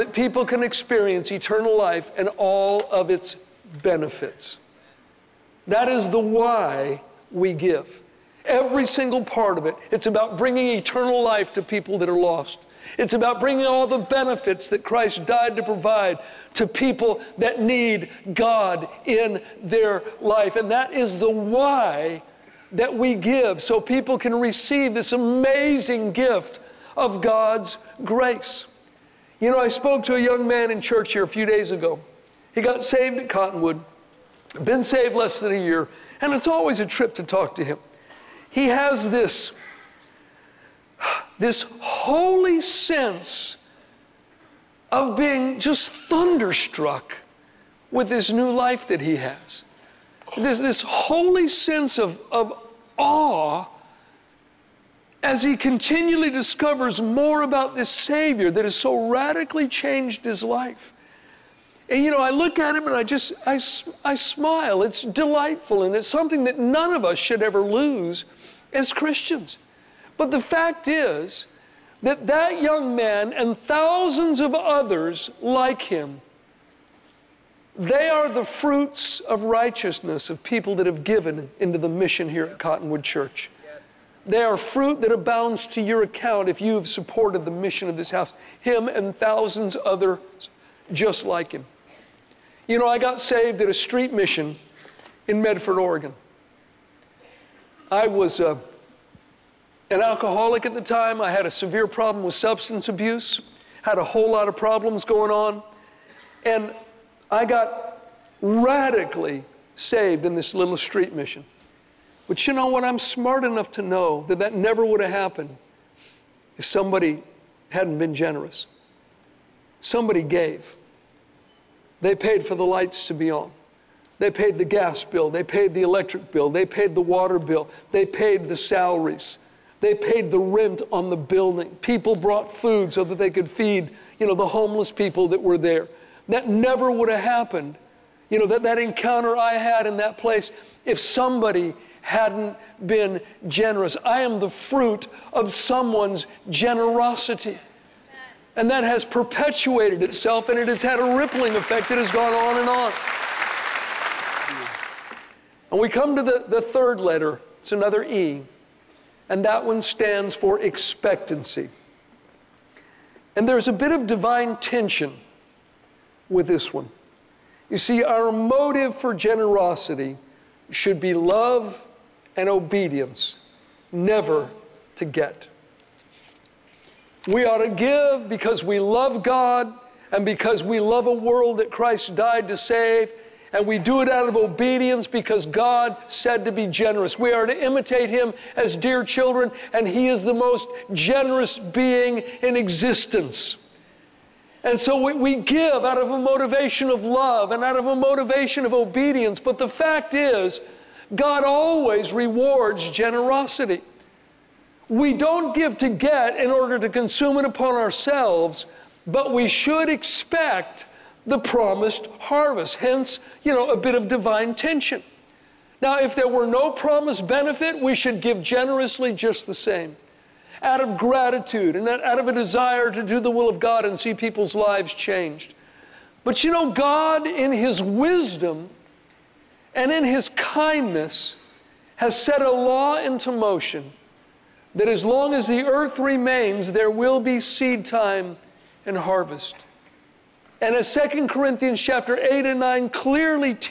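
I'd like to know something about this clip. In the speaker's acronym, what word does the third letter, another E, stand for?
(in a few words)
Expectancy.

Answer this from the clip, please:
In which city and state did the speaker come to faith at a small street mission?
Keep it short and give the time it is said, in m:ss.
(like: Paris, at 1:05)
Medford, Oregon, at 1:35.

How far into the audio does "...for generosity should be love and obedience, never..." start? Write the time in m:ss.
2:48.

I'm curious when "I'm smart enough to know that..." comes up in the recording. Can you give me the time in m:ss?
1:52.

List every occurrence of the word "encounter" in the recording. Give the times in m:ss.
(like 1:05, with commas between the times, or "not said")
2:18.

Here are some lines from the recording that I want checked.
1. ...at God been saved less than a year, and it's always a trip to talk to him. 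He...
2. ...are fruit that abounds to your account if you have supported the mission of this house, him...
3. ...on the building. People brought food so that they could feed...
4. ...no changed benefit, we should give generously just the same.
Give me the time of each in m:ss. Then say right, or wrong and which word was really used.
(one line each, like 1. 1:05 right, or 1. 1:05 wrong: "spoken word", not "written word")
1. 0:33 wrong: "Cottonwood", not "God"
2. 1:24 right
3. 2:10 right
4. 3:36 wrong: "promised", not "changed".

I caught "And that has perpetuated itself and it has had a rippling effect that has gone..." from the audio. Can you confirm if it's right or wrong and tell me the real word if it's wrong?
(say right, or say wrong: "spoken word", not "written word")
right.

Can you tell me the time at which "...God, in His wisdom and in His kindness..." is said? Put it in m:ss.
3:46.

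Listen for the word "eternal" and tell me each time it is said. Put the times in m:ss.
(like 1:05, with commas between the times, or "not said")
0:01, 0:10.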